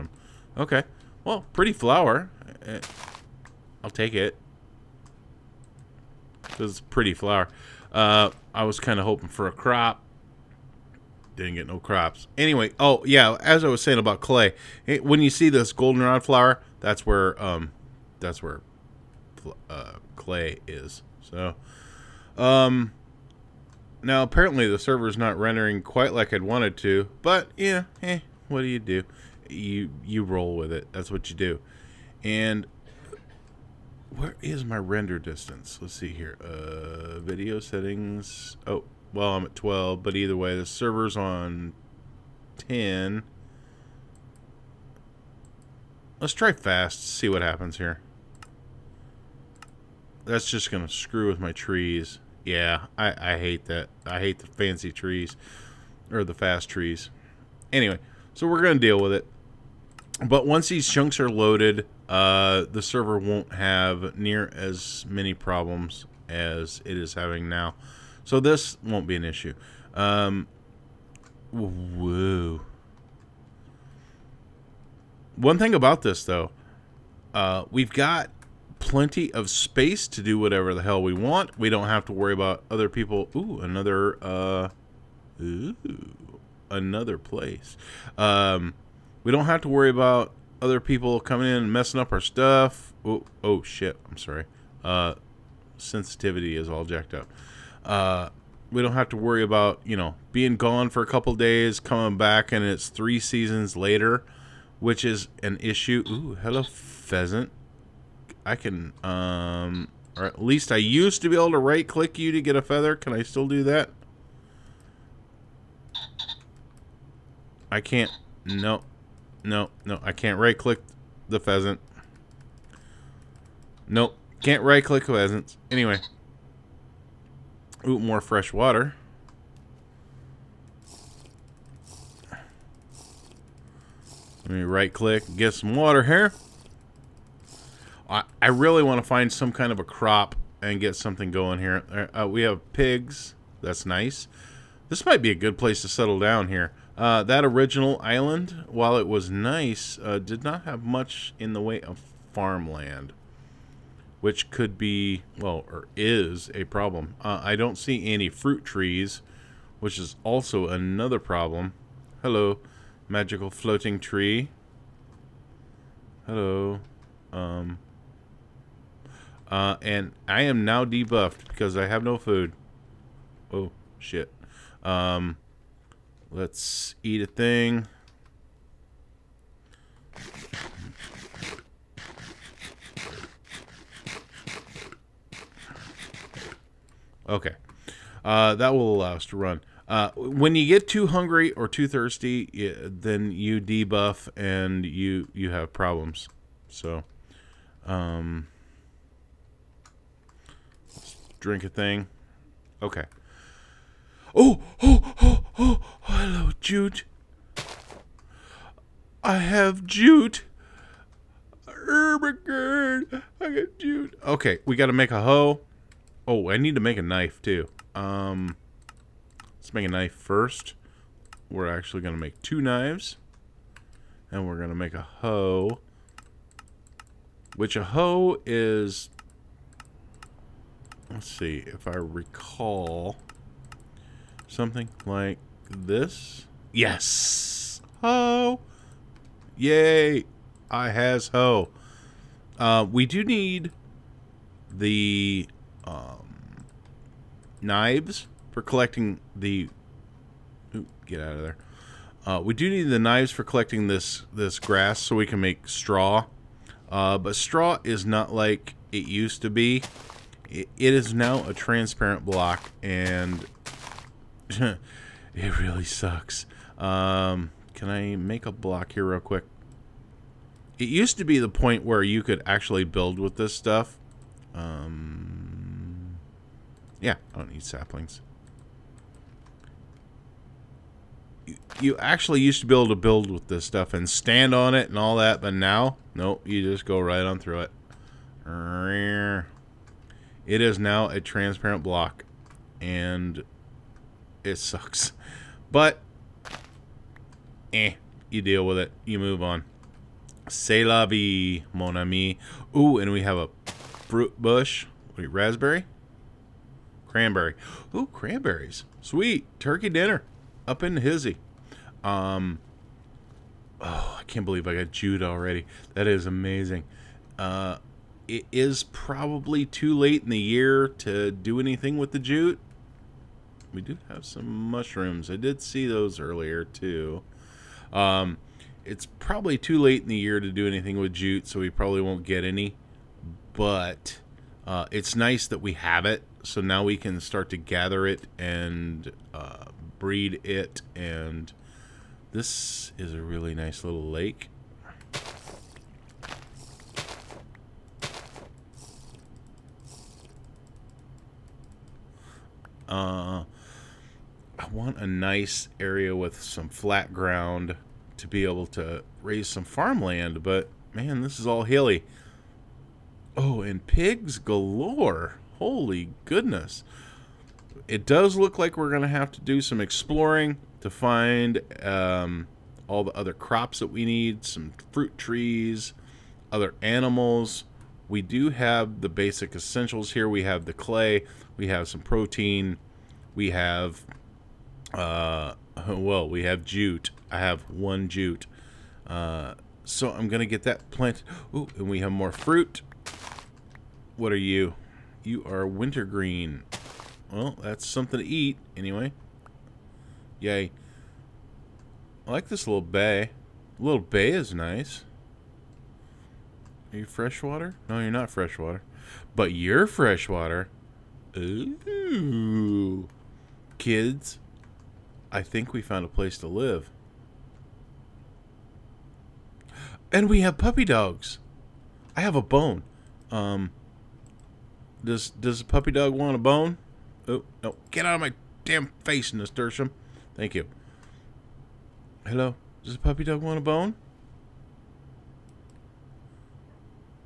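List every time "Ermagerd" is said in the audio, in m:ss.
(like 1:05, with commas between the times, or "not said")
3:31.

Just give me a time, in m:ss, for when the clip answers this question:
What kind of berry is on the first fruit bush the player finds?
5:07.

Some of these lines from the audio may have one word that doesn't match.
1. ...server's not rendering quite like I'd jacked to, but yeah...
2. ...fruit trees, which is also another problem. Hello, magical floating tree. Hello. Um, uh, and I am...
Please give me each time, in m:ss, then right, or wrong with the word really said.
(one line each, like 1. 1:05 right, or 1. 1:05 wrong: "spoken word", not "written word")
1. 0:24 wrong: "wanted", not "jacked"
2. 2:38 right.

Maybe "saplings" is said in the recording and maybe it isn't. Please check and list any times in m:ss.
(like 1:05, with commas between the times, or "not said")
4:37.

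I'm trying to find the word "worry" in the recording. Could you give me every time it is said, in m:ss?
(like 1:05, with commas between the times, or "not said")
1:22, 1:29, 1:39.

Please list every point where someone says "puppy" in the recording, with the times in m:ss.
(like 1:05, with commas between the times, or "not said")
7:00, 7:05, 7:12.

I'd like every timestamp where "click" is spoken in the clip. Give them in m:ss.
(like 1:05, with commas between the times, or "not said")
1:51, 2:00, 2:04, 2:14.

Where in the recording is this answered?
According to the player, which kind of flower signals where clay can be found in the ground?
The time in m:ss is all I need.
0:15.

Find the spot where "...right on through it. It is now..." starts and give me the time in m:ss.
4:46.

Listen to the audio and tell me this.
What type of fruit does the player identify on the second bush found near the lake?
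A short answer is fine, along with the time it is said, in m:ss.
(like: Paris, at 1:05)
Wintergreen, at 6:35.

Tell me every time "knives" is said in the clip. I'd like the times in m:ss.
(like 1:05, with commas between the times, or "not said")
3:42, 4:07, 4:12.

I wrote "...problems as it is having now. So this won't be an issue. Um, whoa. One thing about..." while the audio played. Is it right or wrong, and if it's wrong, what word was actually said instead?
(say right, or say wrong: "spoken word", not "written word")
right.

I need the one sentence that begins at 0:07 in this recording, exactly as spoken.
Uh, I was kind of hoping for a crop.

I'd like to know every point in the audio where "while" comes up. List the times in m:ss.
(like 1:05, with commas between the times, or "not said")
2:28.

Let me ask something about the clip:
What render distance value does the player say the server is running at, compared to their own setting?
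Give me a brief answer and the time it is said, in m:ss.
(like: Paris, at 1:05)
10, at 0:42.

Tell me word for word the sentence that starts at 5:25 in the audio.
I did see those earlier, too.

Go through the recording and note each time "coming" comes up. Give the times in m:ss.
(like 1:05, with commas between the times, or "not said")
1:31, 1:41.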